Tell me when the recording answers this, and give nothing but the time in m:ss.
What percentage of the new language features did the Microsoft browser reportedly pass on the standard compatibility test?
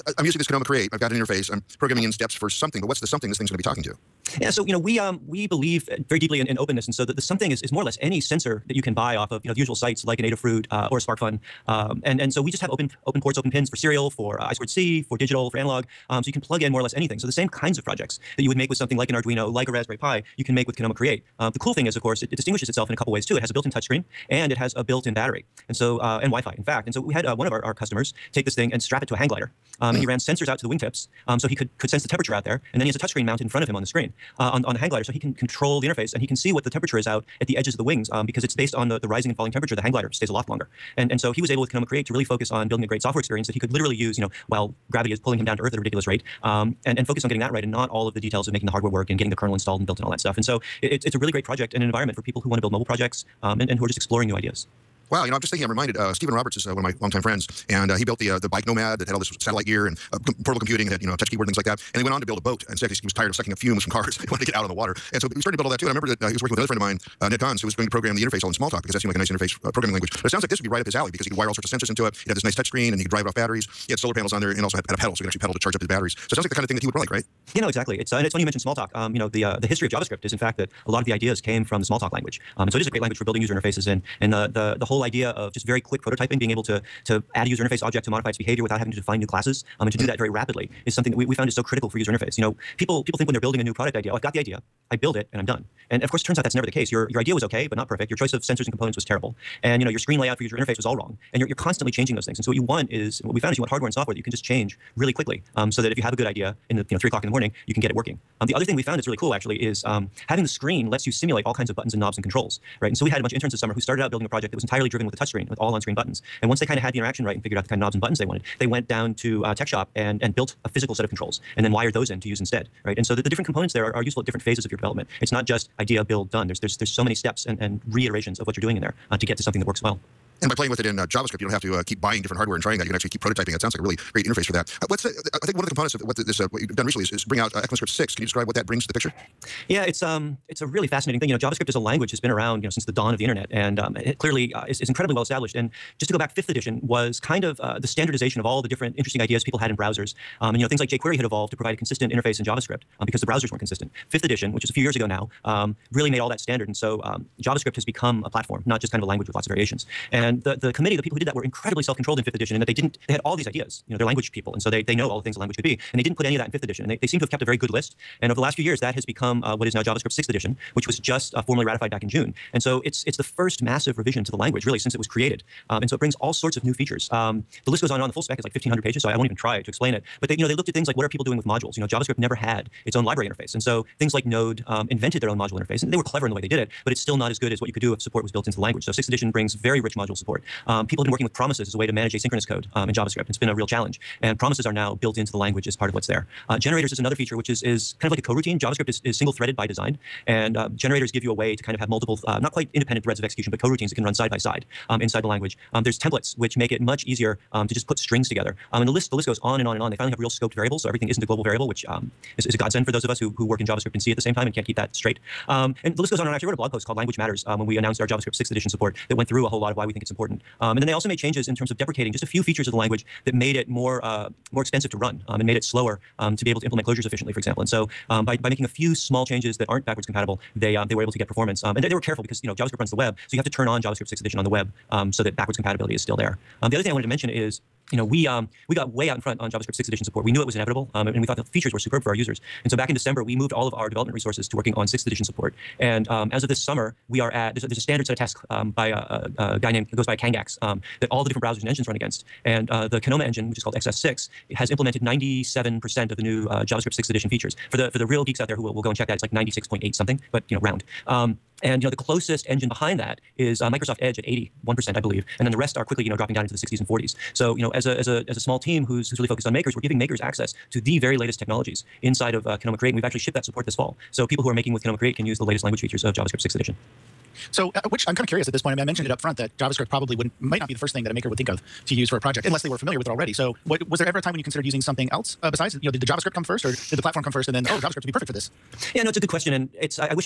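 4:24.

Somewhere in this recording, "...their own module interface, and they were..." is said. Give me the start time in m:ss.
3:05.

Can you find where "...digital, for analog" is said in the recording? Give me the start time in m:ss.
0:15.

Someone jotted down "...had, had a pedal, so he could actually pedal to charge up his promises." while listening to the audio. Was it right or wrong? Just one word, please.
wrong.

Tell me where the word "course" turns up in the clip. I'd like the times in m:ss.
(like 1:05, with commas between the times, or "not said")
0:22, 1:36.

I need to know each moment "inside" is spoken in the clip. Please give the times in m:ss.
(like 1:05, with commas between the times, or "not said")
3:25, 4:32.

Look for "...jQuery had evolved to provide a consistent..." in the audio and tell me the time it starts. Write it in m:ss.
2:30.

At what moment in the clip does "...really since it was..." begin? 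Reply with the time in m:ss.
2:54.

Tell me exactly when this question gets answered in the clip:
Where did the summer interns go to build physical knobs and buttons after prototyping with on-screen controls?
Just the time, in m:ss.
1:59.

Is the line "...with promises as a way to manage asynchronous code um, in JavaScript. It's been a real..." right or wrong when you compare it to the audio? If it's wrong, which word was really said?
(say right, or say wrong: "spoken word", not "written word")
right.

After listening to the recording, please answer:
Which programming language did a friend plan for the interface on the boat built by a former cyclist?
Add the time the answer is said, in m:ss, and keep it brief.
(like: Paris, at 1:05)
Smalltalk, at 1:08.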